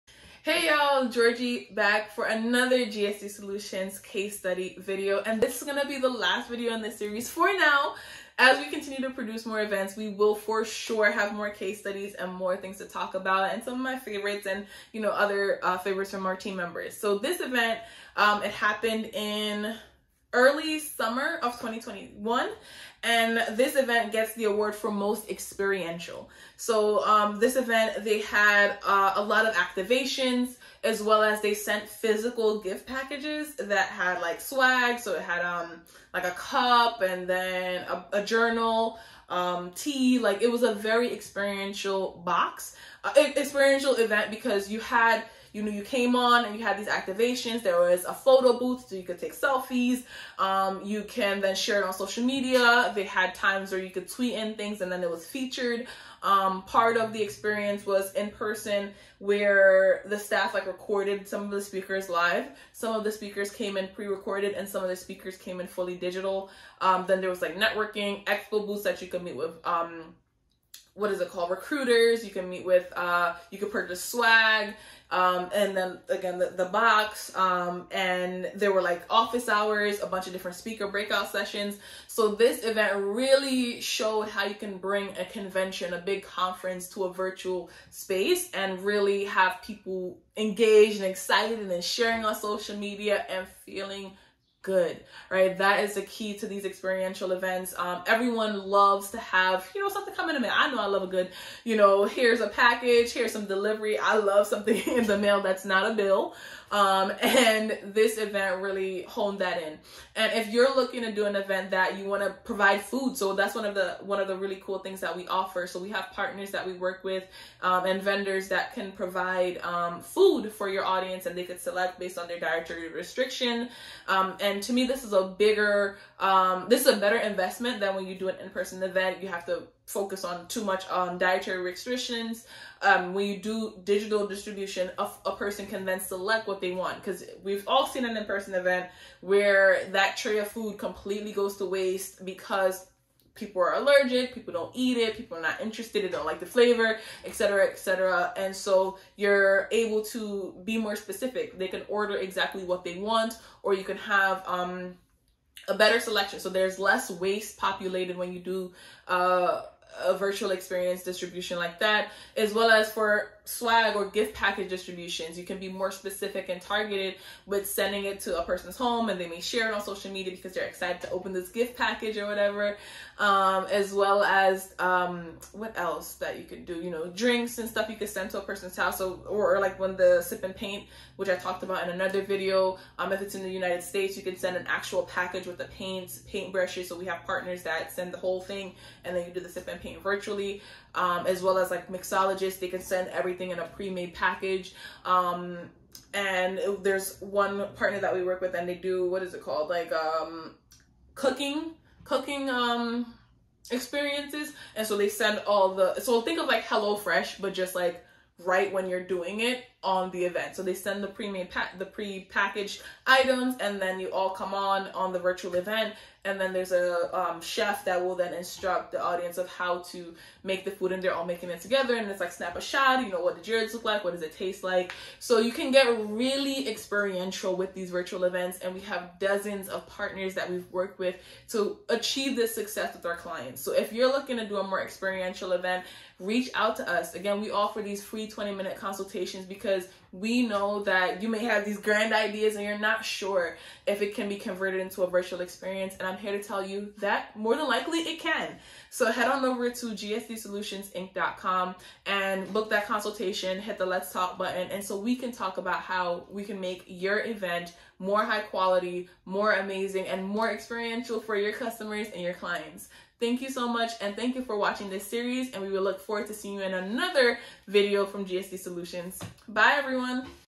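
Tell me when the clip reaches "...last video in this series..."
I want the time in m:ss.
0:06.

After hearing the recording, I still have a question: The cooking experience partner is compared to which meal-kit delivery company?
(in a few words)
HelloFresh.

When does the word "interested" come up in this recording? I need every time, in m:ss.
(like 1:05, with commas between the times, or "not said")
2:25.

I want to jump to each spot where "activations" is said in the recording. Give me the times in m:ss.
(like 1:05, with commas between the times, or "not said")
0:29, 0:46.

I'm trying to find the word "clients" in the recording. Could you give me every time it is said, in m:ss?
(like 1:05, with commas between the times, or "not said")
3:53, 4:22.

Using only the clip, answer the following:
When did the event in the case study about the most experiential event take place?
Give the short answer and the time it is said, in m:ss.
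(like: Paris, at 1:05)
early summer of 2021, at 0:20.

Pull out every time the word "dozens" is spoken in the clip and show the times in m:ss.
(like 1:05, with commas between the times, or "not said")
3:49.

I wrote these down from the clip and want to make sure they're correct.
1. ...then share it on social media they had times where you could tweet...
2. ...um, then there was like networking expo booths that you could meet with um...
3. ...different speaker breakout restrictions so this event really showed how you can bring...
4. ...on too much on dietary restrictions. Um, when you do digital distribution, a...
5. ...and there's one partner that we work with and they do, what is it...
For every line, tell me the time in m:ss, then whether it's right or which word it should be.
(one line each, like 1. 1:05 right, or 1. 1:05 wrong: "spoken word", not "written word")
1. 0:51 right
2. 1:06 right
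3. 1:20 wrong: "sessions", not "restrictions"
4. 2:10 right
5. 3:16 right.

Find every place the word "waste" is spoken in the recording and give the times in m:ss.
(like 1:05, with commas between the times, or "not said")
2:21, 2:37.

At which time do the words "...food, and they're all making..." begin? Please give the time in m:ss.
3:40.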